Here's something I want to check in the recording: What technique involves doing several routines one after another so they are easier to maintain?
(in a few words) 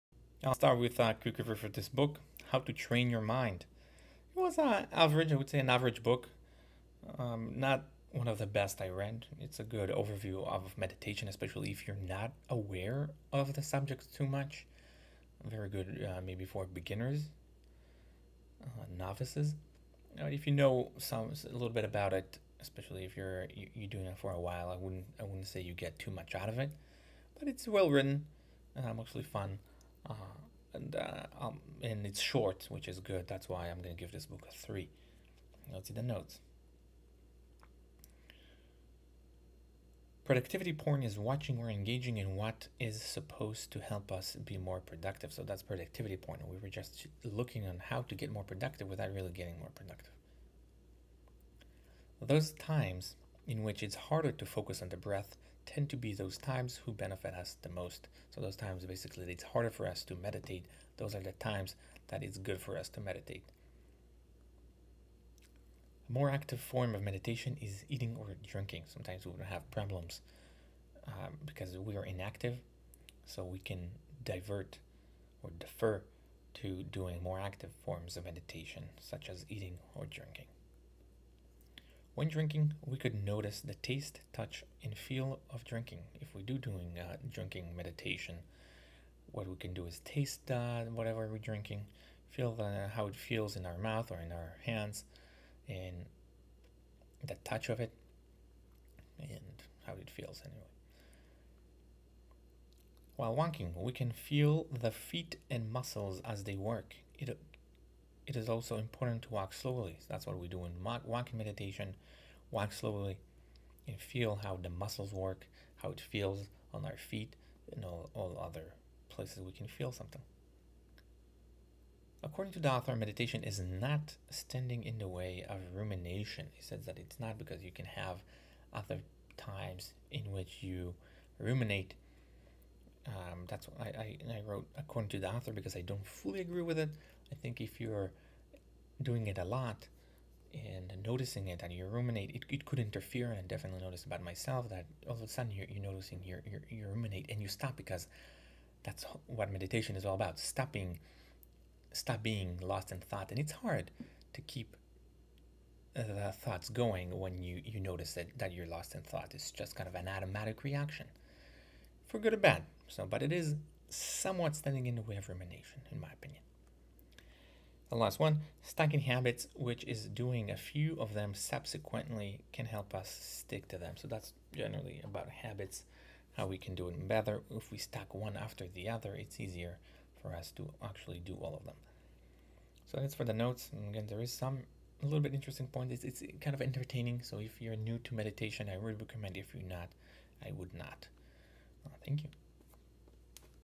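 Stacking habits.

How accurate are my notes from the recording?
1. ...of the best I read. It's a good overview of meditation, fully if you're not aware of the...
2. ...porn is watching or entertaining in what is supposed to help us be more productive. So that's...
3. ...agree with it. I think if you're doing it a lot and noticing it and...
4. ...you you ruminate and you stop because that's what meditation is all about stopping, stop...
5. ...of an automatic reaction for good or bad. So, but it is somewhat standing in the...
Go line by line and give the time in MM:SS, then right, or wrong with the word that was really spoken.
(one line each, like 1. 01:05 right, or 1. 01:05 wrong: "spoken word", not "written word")
1. 00:08 wrong: "especially", not "fully"
2. 00:40 wrong: "engaging", not "entertaining"
3. 02:16 right
4. 02:26 right
5. 02:39 right.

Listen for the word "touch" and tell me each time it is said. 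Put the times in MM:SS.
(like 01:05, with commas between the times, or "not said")
01:24, 01:37.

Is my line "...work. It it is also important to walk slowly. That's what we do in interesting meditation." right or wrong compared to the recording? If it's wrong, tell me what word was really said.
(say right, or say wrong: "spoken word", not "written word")
wrong: "walking", not "interesting".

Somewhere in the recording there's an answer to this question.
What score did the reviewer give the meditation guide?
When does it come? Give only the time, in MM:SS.
00:34.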